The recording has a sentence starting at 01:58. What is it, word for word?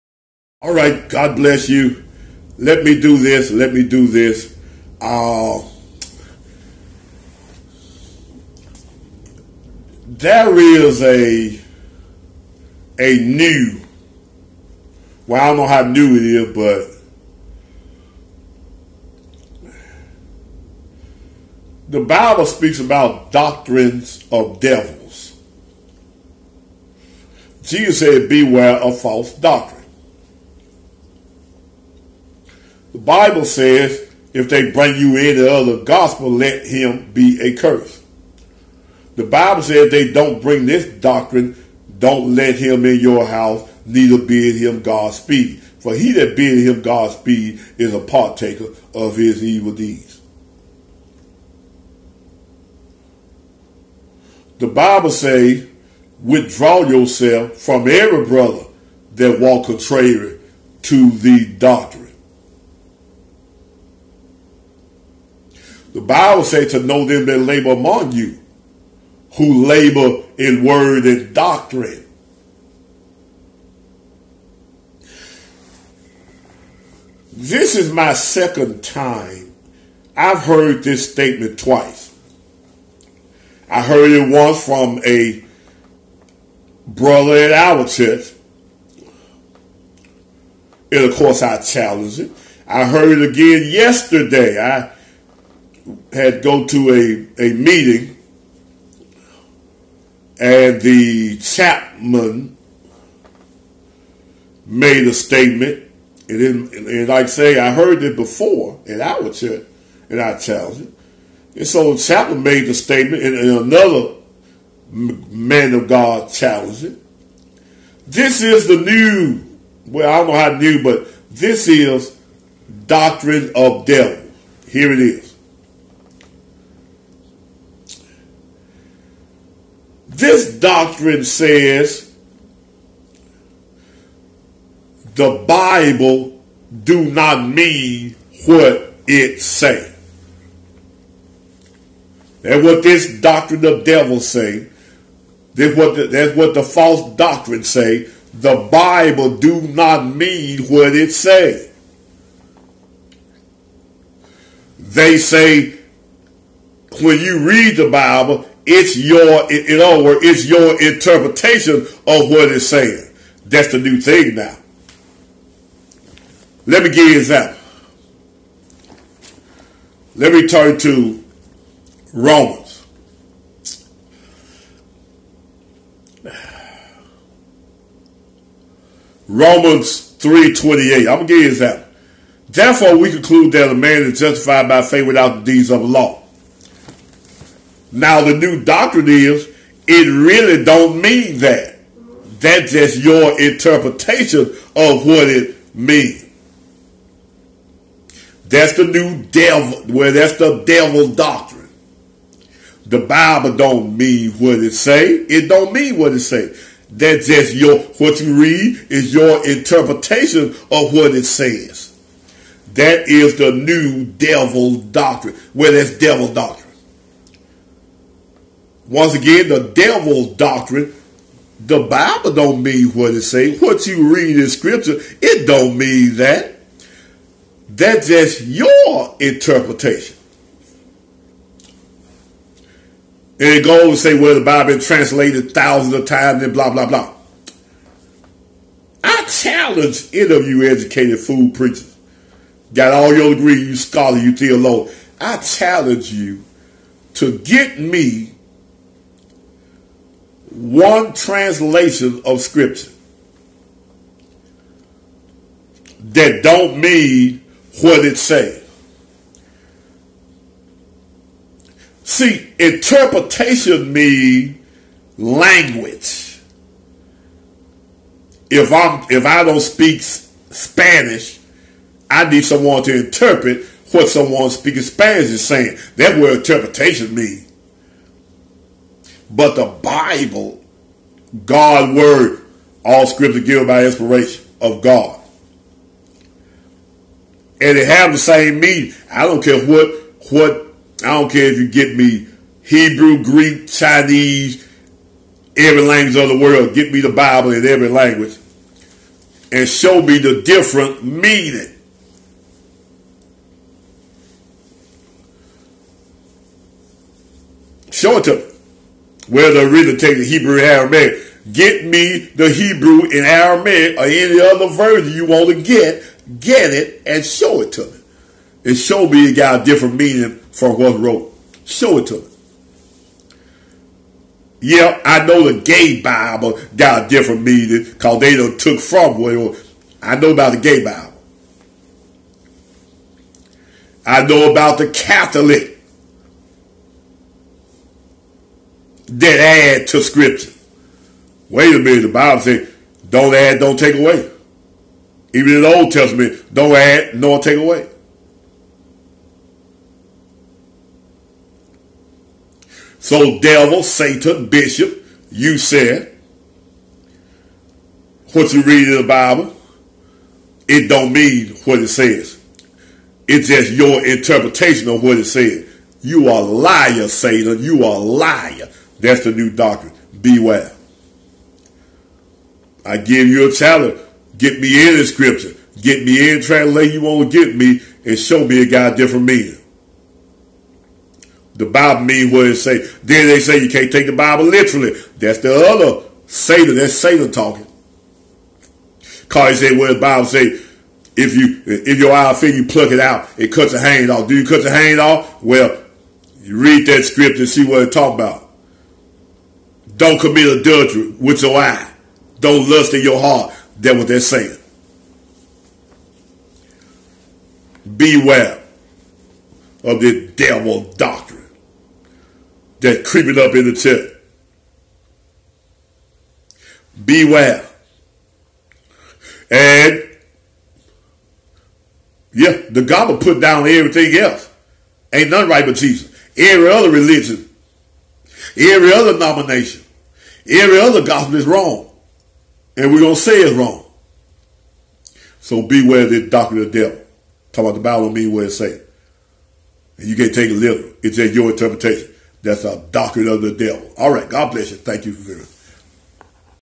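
This is the new, well, I don't know how new, but this is doctrine of devil.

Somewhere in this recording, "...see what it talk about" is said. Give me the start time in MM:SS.
06:37.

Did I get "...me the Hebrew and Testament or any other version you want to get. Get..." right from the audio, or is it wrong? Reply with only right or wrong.
wrong.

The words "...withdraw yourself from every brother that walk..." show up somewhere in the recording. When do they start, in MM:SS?
00:56.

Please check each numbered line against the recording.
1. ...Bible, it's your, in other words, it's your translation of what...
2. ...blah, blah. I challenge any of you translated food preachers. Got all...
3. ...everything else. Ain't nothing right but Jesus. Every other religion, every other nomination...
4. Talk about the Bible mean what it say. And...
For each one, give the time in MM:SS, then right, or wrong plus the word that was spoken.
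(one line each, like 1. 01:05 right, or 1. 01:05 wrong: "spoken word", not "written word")
1. 02:37 wrong: "interpretation", not "translation"
2. 03:56 wrong: "educated", not "translated"
3. 07:03 right
4. 07:17 right.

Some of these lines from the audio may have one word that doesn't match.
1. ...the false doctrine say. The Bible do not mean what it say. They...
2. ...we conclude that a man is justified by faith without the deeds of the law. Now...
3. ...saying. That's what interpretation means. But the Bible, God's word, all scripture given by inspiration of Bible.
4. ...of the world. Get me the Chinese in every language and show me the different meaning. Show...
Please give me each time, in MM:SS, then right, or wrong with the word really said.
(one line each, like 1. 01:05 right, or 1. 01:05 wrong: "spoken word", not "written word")
1. 02:26 right
2. 03:02 right
3. 04:35 wrong: "God", not "Bible"
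4. 04:56 wrong: "Bible", not "Chinese".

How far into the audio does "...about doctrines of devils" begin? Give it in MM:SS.
00:22.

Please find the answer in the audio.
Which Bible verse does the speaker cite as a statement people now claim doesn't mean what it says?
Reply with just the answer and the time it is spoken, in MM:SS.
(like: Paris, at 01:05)
Romans 3:28, at 02:59.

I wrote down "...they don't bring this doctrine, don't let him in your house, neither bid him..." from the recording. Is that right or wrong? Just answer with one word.
right.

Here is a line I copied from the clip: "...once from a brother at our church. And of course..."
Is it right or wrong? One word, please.
right.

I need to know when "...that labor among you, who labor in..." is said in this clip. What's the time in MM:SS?
01:07.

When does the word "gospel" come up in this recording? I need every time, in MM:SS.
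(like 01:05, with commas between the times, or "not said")
00:35, 07:02, 07:11.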